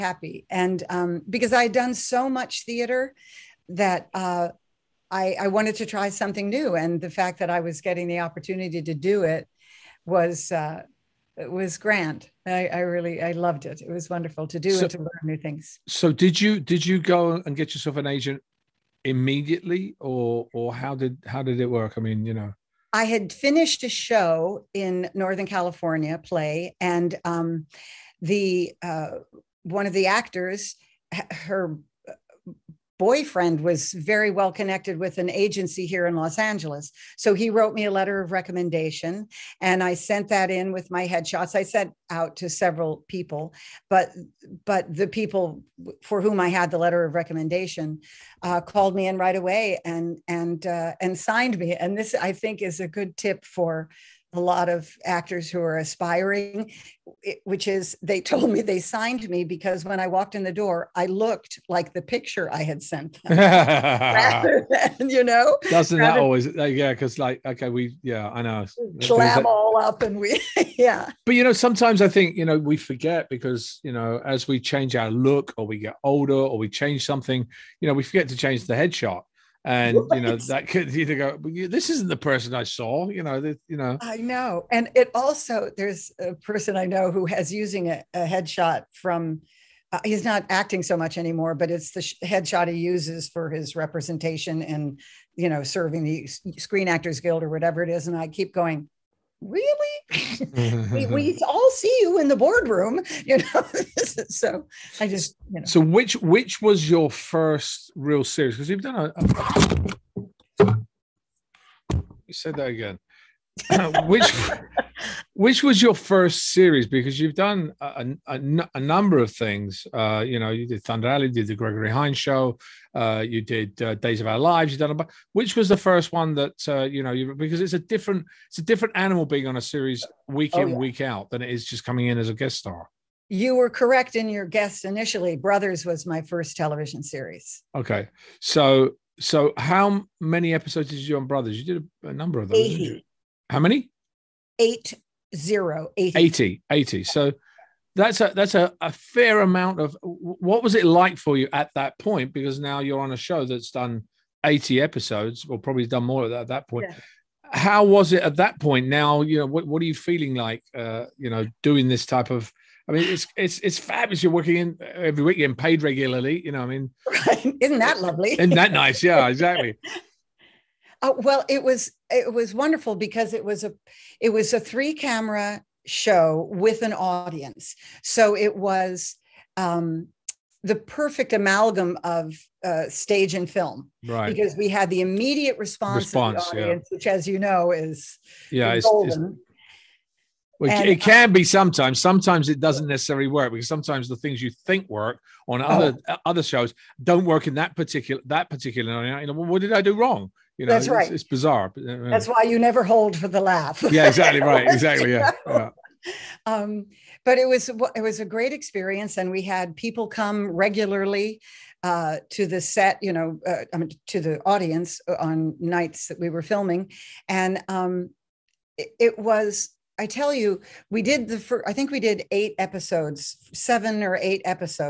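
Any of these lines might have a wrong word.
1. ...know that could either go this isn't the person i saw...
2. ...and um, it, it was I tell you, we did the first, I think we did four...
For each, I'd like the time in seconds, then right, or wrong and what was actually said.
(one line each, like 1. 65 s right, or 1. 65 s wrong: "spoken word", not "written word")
1. 80 s right
2. 217 s wrong: "eight", not "four".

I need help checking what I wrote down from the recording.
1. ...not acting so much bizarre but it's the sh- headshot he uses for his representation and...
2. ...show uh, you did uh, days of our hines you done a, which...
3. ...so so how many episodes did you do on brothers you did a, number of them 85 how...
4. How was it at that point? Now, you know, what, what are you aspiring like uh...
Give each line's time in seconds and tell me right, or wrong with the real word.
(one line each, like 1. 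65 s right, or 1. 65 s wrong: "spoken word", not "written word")
1. 90 s wrong: "anymore", not "bizarre"
2. 122 s wrong: "lives", not "hines"
3. 138 s wrong: "80", not "85"
4. 157 s wrong: "feeling", not "aspiring".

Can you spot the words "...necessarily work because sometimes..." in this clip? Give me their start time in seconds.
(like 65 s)
192 s.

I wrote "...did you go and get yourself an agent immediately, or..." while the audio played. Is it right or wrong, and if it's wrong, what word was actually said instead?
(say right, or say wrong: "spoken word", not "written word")
right.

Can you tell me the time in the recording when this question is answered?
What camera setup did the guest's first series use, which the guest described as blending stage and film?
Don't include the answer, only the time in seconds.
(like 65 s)
174 s.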